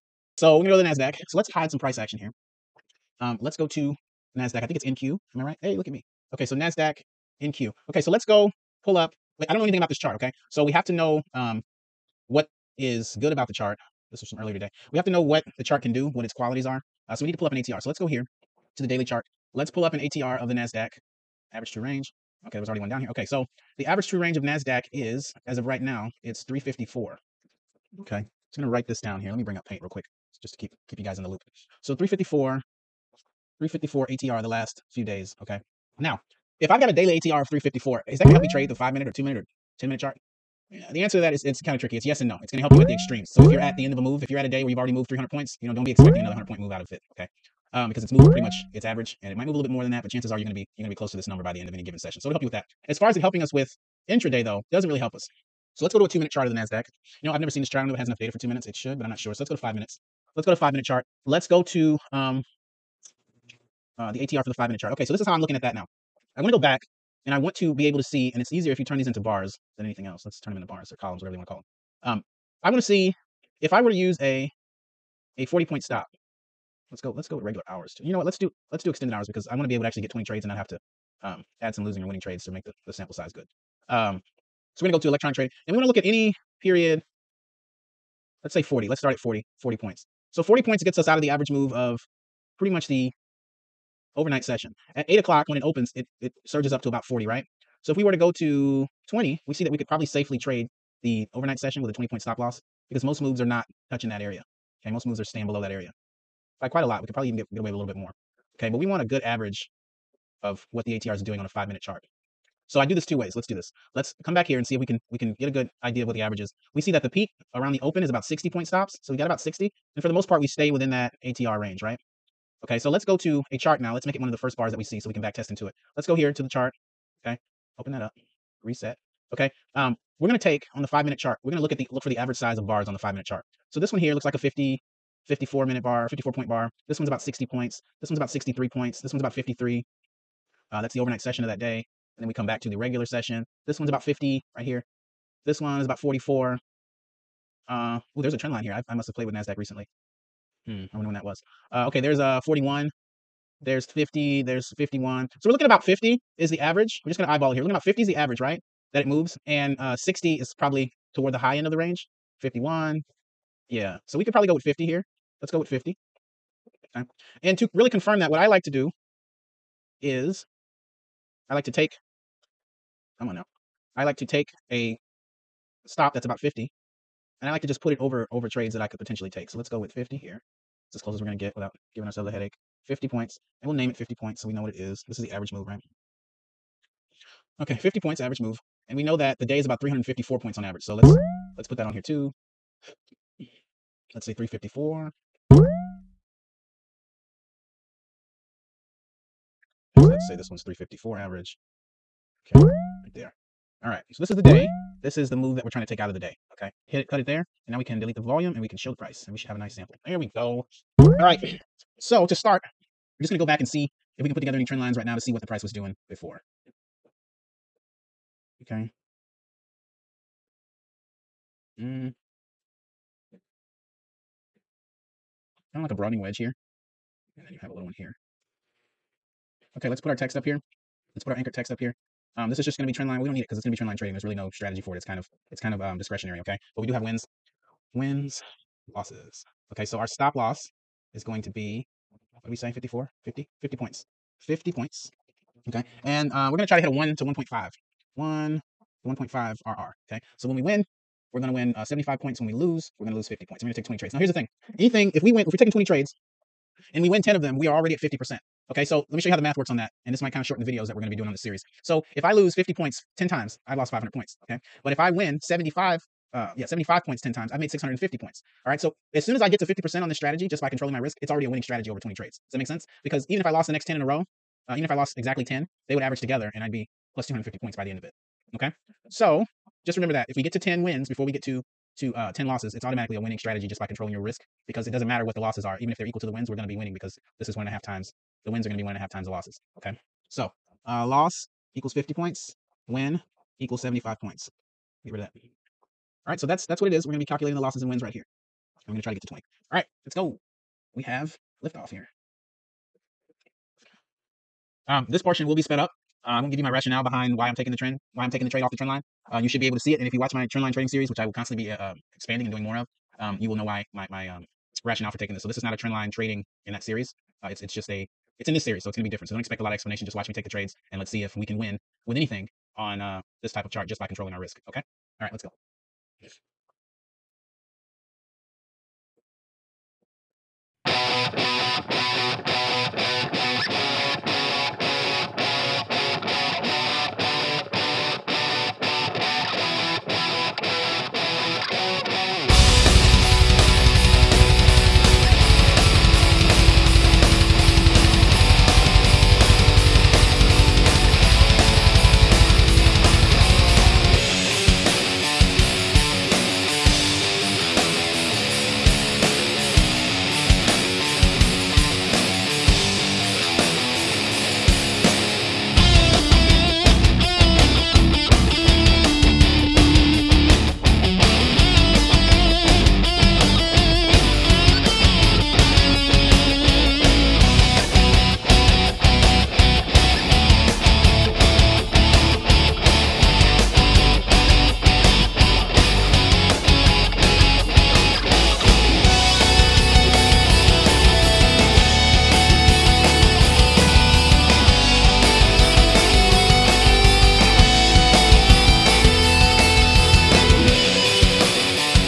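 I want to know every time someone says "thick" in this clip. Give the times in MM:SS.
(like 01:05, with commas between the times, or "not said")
not said.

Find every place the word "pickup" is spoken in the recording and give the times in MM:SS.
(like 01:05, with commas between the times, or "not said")
not said.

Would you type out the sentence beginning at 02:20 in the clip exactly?
Uh, that's the overnight session of that day.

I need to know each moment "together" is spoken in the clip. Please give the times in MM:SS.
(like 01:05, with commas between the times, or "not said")
03:34, 04:36.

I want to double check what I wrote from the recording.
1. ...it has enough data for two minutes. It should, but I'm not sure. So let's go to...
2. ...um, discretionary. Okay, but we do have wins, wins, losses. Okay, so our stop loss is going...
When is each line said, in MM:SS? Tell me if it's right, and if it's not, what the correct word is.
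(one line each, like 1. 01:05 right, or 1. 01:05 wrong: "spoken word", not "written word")
1. 00:57 right
2. 03:55 right.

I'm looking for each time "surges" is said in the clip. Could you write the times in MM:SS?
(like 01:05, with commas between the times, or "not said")
01:36.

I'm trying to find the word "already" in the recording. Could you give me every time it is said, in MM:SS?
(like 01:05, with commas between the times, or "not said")
00:22, 00:44, 04:17, 04:31.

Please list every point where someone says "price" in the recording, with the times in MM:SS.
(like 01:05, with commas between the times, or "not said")
00:01, 03:28, 03:35.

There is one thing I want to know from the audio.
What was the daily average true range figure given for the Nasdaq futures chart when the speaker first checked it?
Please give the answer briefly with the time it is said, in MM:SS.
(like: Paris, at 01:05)
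354, at 00:26.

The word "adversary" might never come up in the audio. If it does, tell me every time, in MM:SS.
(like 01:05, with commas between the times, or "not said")
not said.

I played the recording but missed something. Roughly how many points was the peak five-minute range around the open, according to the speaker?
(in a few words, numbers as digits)
60.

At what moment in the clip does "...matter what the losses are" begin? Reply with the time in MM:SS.
04:45.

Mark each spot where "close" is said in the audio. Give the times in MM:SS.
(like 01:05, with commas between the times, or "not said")
00:50, 03:01.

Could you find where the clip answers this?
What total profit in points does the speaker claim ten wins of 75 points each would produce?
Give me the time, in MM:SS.
04:27.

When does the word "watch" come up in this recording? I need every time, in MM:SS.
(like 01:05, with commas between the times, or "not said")
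05:10, 05:20.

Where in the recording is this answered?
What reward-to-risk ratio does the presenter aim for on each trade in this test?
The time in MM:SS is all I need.
04:06.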